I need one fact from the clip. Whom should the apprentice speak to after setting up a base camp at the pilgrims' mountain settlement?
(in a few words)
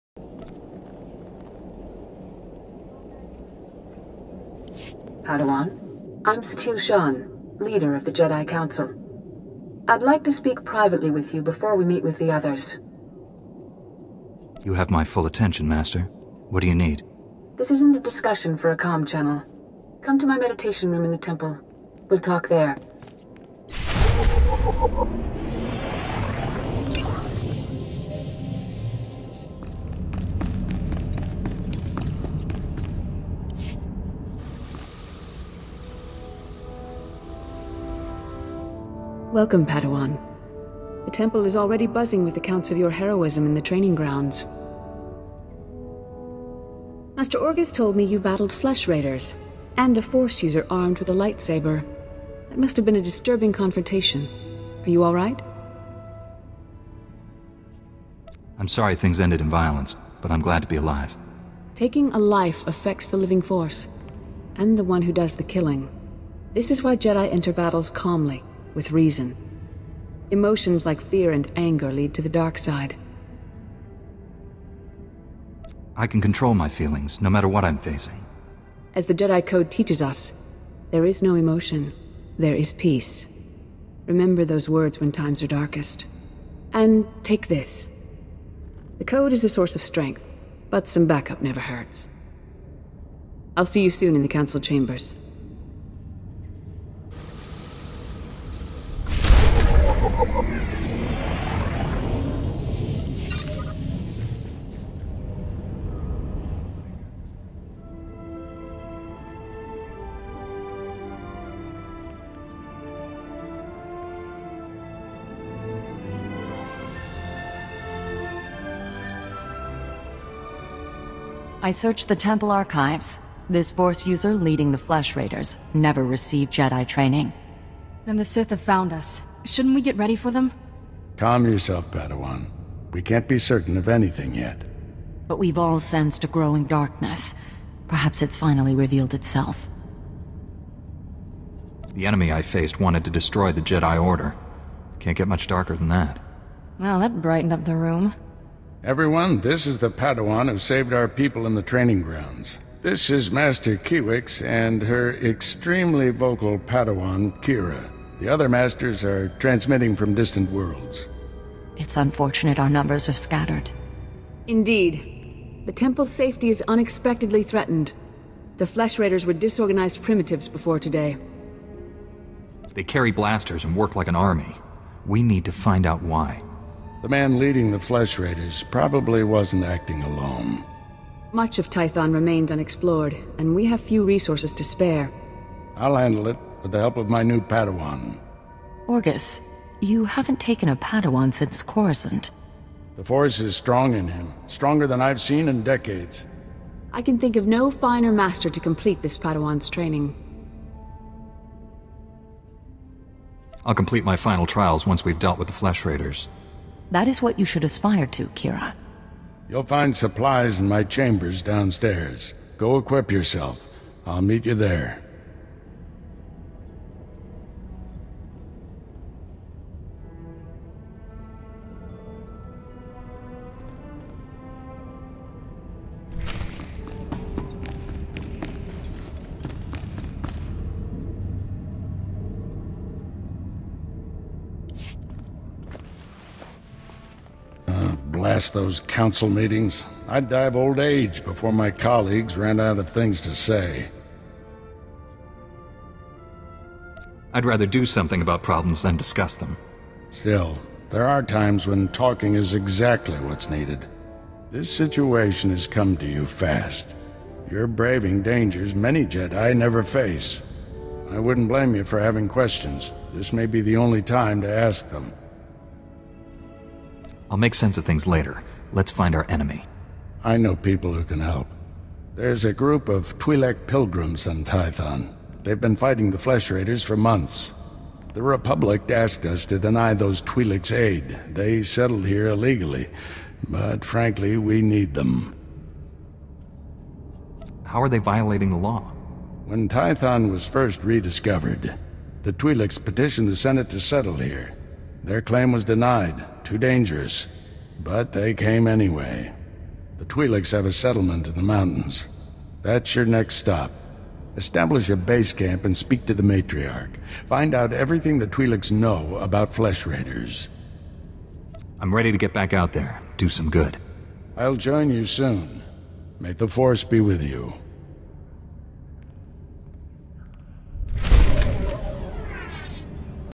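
The Matriarch.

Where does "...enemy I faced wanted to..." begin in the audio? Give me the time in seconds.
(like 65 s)
142 s.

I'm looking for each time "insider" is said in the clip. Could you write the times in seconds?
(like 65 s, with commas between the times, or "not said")
not said.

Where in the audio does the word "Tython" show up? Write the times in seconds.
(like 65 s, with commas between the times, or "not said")
181 s, 274 s, 289 s.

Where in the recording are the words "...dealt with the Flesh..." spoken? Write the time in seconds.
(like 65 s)
205 s.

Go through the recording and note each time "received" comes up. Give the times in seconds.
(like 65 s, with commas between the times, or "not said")
126 s.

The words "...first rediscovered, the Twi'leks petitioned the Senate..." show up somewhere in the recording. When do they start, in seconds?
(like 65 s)
290 s.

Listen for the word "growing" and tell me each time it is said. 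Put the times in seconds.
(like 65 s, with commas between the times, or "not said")
136 s.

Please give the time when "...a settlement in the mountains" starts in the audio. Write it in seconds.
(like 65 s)
300 s.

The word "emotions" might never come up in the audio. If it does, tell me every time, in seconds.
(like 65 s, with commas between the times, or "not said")
70 s, 81 s.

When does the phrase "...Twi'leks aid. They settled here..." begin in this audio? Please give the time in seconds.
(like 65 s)
280 s.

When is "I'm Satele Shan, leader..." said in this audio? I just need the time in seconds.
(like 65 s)
6 s.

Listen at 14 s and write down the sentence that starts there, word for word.
You have my full attention, Master.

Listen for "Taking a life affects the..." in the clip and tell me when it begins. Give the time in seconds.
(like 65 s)
61 s.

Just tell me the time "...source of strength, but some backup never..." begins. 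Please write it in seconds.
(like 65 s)
89 s.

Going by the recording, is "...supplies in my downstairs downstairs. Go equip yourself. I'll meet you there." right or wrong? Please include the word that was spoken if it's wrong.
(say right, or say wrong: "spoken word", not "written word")
wrong: "chambers", not "downstairs".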